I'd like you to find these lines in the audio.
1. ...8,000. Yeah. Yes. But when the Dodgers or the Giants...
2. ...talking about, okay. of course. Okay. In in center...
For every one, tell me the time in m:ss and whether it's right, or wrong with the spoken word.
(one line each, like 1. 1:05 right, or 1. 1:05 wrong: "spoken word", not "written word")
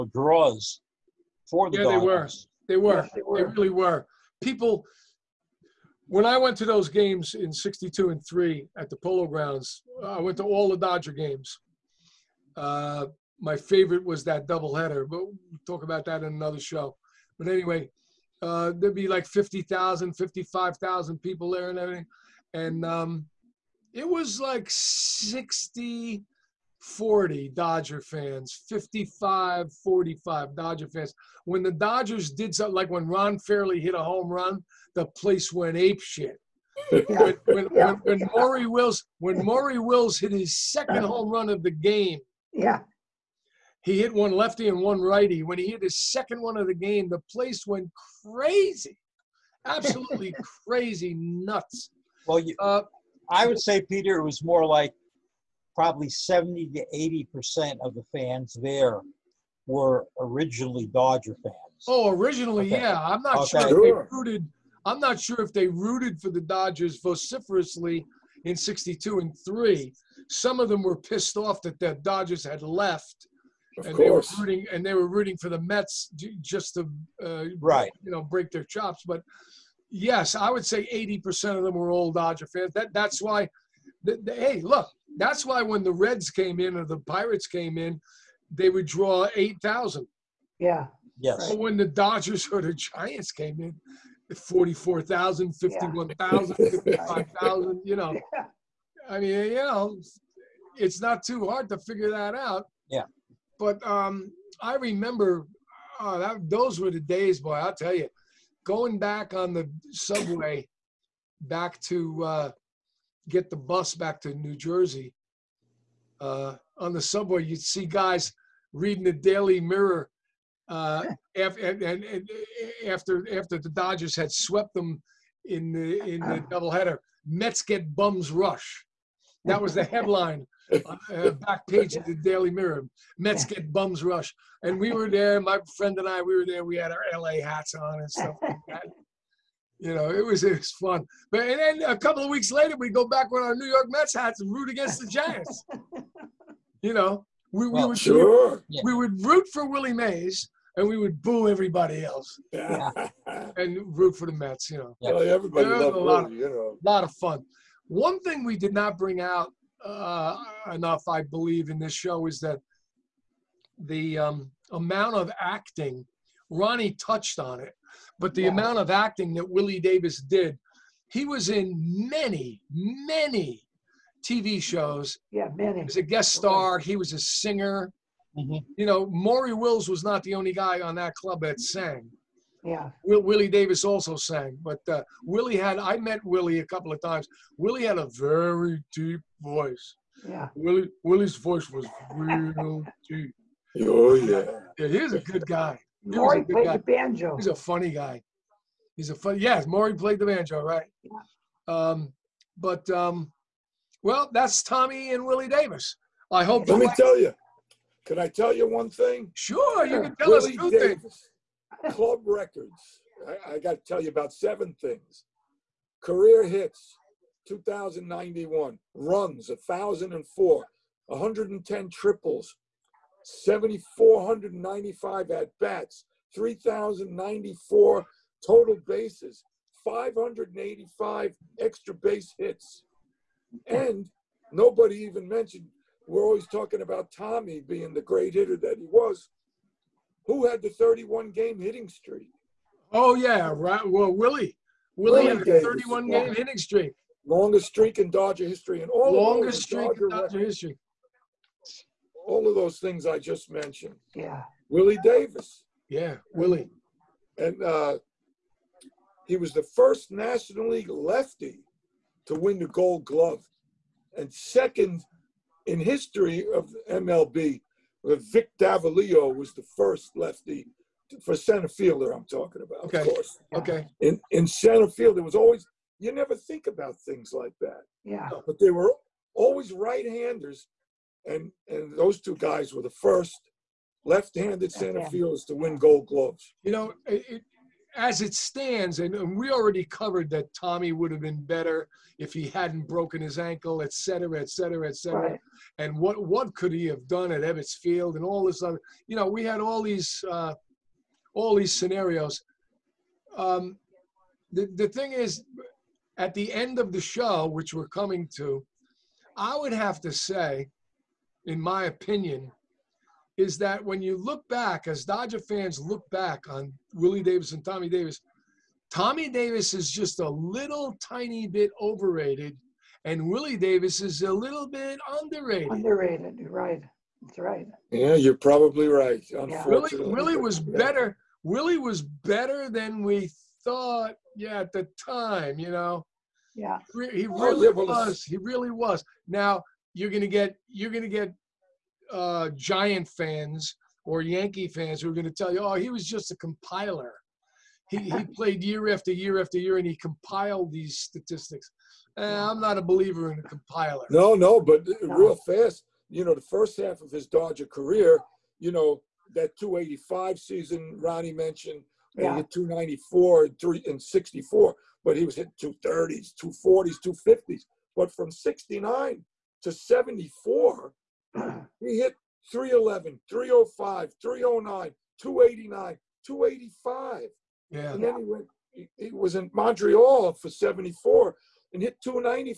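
1. 1:29 right
2. 4:32 right.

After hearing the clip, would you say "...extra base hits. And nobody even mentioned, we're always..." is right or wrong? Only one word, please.
right.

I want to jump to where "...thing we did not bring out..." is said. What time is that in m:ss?
2:38.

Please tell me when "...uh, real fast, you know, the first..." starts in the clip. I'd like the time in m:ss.
5:54.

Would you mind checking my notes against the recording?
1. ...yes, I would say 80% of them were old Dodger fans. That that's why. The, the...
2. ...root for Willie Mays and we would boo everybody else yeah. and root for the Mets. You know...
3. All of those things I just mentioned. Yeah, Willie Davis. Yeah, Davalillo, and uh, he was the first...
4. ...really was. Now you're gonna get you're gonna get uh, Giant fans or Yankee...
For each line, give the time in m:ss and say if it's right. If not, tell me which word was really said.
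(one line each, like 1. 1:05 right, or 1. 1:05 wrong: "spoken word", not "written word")
1. 1:19 right
2. 2:29 right
3. 4:12 wrong: "Willie", not "Davalillo"
4. 5:38 right.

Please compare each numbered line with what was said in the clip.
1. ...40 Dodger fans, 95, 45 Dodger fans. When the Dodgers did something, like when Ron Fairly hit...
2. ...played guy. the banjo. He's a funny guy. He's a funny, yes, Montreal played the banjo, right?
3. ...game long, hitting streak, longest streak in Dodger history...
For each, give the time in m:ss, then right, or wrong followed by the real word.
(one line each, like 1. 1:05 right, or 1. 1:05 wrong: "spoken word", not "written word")
1. 0:26 wrong: "55", not "95"
2. 3:16 wrong: "Maury", not "Montreal"
3. 4:06 right.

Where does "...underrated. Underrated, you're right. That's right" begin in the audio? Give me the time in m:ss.
5:25.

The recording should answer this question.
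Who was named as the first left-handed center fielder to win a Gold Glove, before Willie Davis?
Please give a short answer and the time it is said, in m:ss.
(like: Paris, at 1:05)
Vic Davalillo, at 4:28.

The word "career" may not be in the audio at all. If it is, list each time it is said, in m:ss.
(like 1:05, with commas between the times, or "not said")
3:36, 5:57.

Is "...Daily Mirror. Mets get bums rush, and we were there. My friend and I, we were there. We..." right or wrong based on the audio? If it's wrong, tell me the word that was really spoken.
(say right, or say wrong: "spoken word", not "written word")
right.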